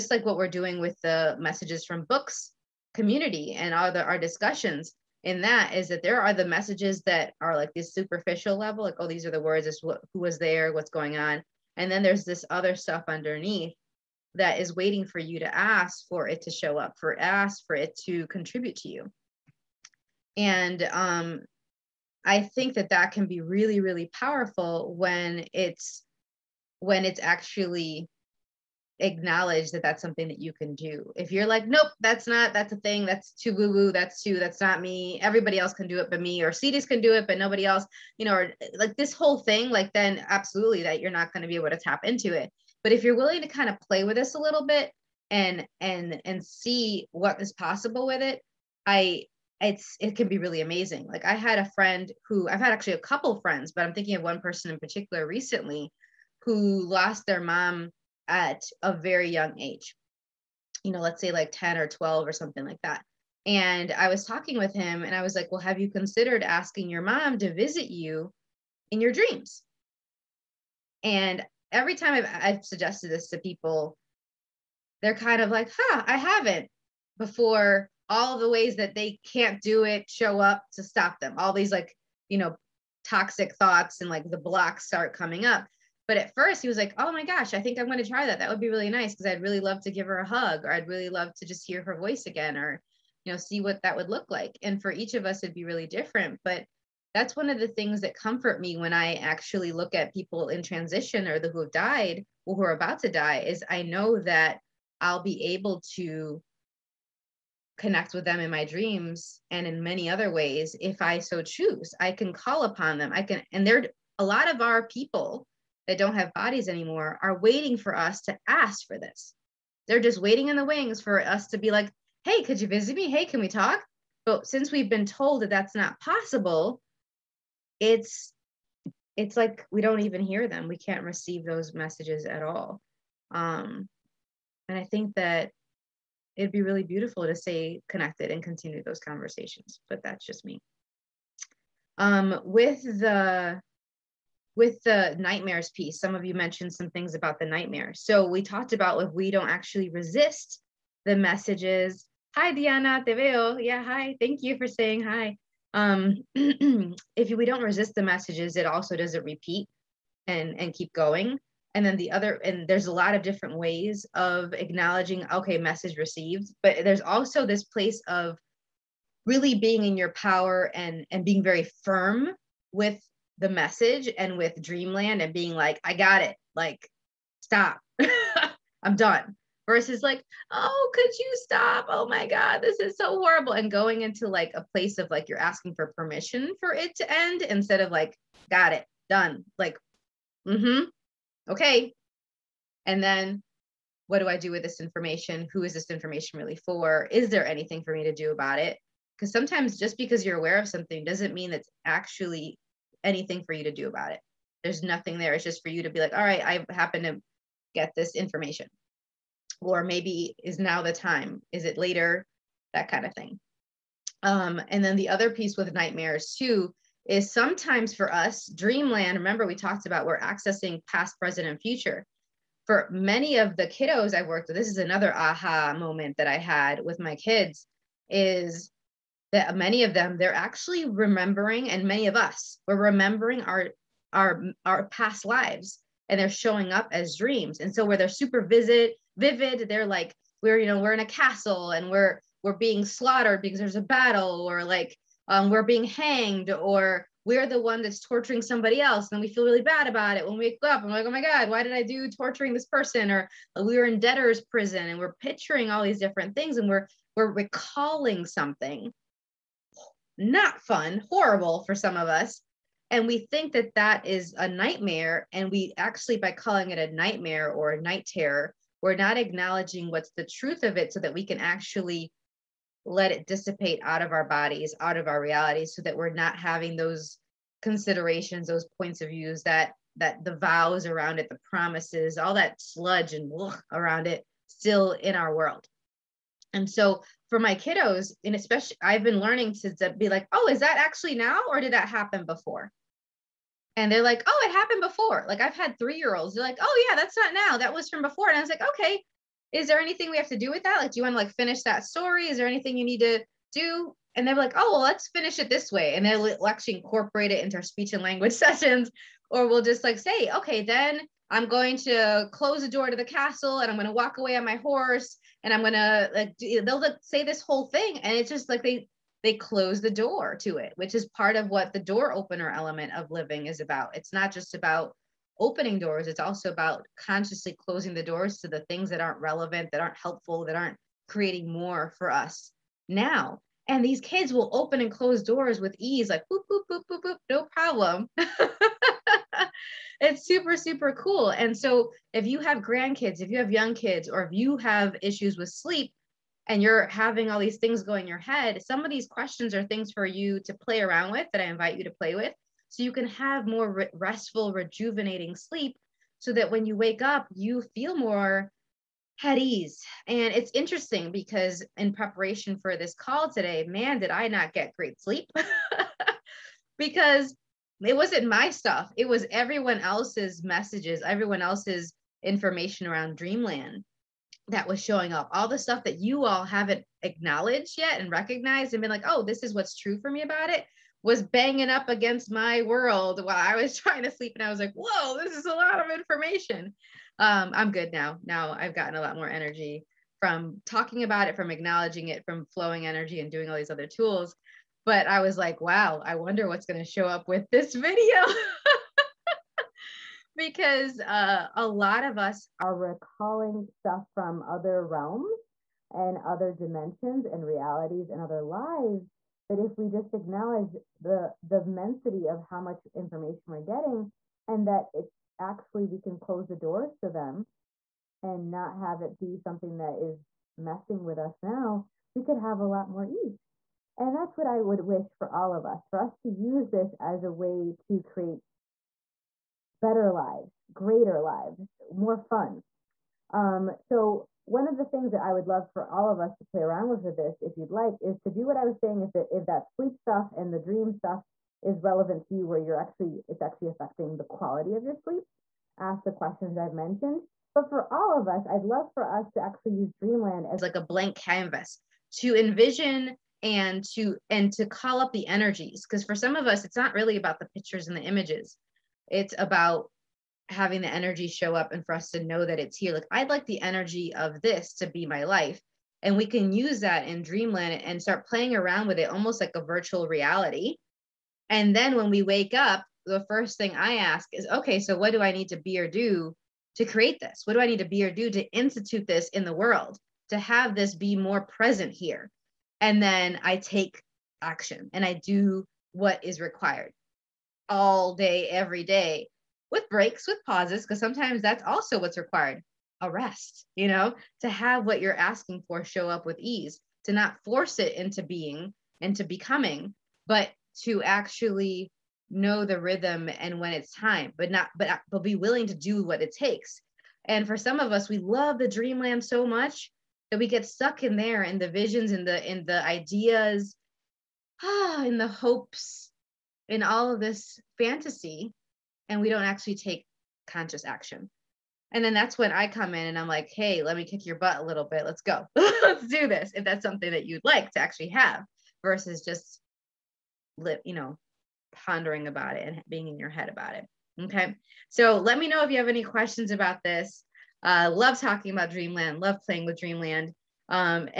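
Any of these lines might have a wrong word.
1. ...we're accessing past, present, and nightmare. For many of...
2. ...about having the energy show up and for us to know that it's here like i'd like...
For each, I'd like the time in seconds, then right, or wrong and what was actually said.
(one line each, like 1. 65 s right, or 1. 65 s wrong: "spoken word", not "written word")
1. 220 s wrong: "future", not "nightmare"
2. 459 s right.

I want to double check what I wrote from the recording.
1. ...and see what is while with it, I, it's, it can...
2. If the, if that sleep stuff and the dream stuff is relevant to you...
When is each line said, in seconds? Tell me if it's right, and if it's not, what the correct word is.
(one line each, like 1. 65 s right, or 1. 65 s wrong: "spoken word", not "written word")
1. 46 s wrong: "possible", not "while"
2. 439 s right.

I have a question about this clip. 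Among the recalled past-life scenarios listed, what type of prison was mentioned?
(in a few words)
Debtor's prison.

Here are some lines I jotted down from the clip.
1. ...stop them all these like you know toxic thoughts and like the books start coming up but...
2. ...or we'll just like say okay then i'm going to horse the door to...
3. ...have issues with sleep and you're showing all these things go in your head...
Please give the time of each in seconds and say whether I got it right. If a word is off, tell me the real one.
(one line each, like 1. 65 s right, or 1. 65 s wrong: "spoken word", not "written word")
1. 80 s wrong: "blocks", not "books"
2. 309 s wrong: "close", not "horse"
3. 344 s wrong: "having", not "showing".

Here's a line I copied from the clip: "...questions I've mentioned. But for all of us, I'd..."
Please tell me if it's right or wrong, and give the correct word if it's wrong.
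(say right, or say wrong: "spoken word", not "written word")
right.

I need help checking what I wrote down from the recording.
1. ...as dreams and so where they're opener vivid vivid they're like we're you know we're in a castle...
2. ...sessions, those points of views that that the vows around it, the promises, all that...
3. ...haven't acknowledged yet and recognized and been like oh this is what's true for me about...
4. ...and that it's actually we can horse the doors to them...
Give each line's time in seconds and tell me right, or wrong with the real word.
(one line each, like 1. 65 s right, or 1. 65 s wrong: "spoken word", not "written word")
1. 236 s wrong: "super", not "opener"
2. 277 s wrong: "considerations", not "sessions"
3. 376 s right
4. 414 s wrong: "close", not "horse".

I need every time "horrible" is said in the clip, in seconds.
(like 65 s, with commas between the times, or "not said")
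183 s, 261 s.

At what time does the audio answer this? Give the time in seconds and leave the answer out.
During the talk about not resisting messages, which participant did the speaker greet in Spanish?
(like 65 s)
152 s.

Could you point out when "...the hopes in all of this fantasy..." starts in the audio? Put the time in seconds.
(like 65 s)
515 s.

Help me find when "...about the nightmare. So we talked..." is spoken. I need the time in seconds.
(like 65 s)
147 s.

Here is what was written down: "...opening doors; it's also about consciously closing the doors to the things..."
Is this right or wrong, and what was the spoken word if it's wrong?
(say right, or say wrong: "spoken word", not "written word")
right.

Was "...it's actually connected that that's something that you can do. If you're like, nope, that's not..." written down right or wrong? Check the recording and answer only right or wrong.
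wrong.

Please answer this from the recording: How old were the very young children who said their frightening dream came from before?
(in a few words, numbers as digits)
3.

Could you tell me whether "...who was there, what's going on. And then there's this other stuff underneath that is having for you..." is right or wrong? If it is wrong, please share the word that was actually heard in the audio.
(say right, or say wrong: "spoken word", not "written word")
wrong: "waiting", not "having".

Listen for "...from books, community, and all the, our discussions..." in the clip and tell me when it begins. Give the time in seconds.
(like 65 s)
1 s.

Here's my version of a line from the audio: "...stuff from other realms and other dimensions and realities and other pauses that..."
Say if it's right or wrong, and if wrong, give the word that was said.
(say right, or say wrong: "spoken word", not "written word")
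wrong: "lives", not "pauses".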